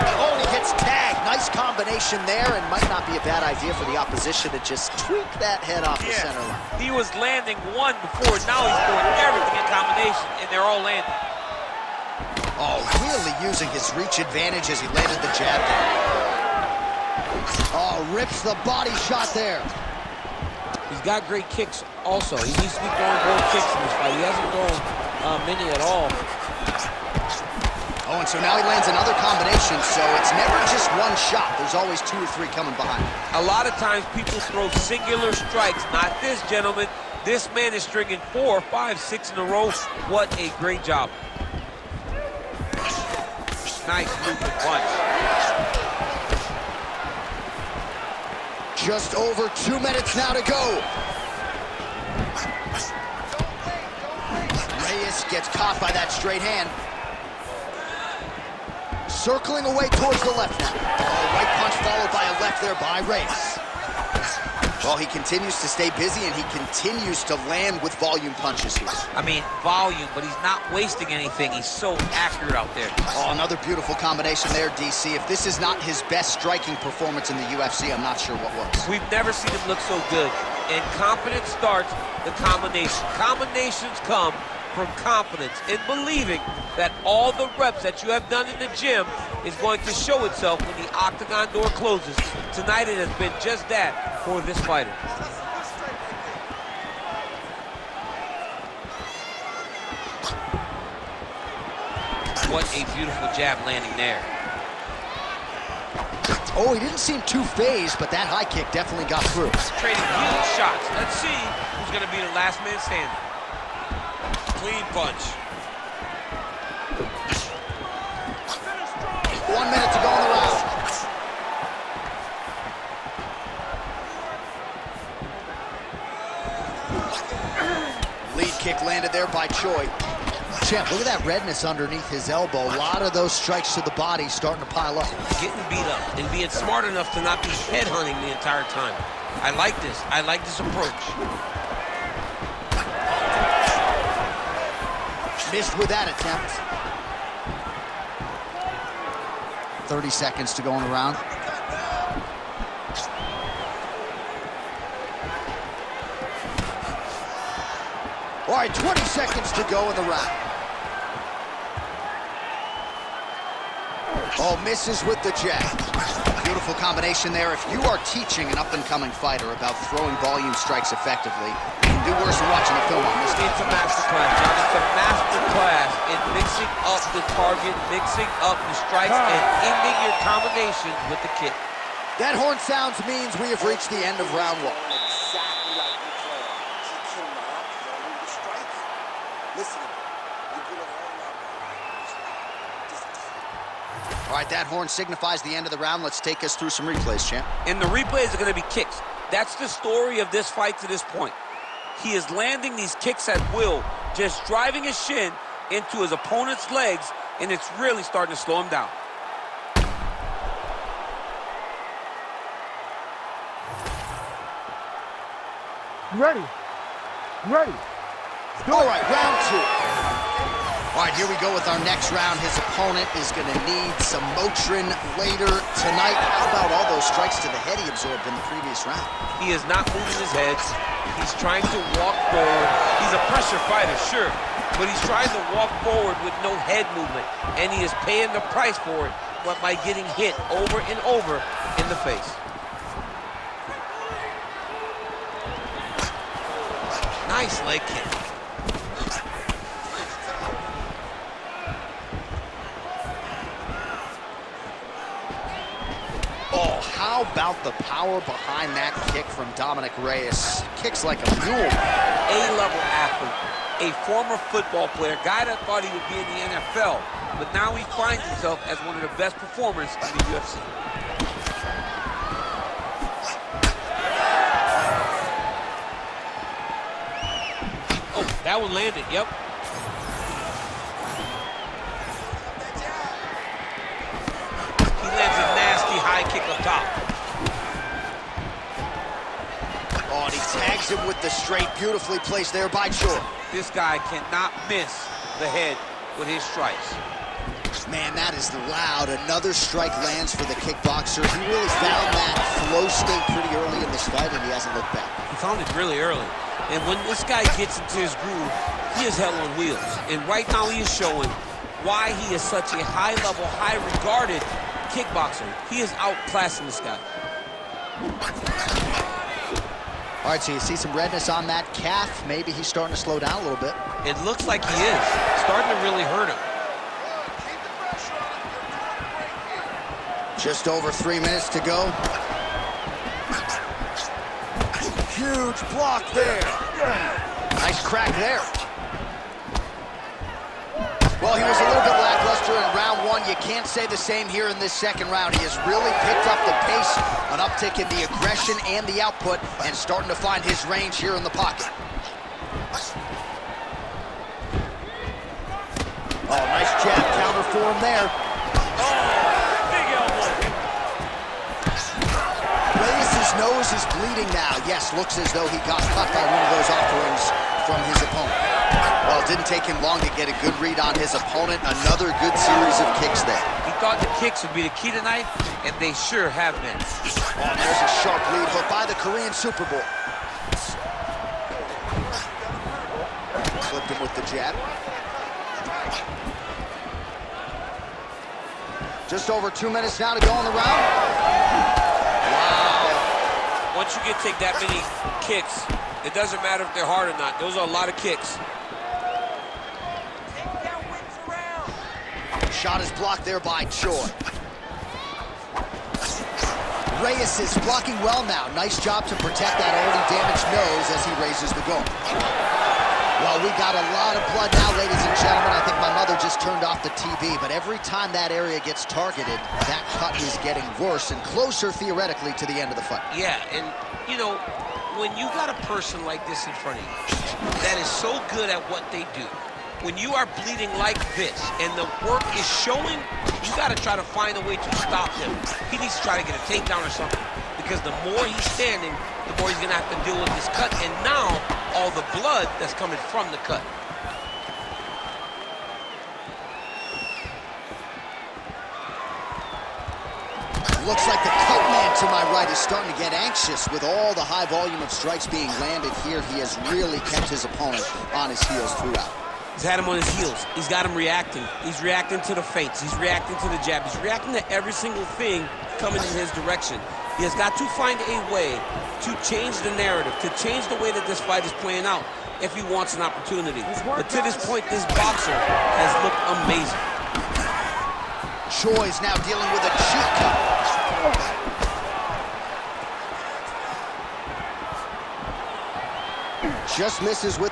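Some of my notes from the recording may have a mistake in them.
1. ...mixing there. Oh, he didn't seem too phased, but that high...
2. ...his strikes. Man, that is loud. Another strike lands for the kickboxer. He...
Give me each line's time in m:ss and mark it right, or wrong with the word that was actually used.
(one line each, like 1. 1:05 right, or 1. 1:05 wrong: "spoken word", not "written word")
1. 1:43 wrong: "landing", not "mixing"
2. 4:56 right.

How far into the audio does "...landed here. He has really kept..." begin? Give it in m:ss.
7:35.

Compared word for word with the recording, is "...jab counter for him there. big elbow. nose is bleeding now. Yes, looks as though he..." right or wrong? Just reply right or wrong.
right.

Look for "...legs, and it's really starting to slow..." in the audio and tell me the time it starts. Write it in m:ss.
3:26.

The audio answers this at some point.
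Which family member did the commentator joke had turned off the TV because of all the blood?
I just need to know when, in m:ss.
6:55.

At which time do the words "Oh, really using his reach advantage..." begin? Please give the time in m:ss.
0:12.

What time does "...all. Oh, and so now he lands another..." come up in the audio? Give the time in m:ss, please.
0:25.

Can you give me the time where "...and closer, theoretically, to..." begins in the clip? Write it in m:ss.
7:01.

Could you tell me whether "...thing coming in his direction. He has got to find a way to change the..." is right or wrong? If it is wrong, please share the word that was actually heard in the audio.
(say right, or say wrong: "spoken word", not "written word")
right.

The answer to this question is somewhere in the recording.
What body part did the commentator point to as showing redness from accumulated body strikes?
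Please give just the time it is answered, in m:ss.
2:11.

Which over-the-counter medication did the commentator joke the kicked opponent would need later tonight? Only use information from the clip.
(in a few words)
Motrin.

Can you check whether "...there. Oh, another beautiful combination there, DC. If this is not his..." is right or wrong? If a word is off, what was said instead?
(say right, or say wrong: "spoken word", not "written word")
right.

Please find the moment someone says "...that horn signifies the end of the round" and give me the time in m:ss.
3:14.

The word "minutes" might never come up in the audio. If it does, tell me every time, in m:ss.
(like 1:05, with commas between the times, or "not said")
0:49, 1:59, 5:31, 6:29.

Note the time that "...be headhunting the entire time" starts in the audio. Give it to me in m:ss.
2:17.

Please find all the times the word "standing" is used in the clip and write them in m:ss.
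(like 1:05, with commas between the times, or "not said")
1:52, 7:18.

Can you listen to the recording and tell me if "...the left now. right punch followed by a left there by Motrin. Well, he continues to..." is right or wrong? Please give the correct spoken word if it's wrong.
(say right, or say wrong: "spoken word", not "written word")
wrong: "Reyes", not "Motrin".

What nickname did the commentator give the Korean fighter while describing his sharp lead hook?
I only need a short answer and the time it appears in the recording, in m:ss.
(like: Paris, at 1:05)
Korean Superboy, at 6:18.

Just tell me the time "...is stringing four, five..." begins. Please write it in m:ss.
0:37.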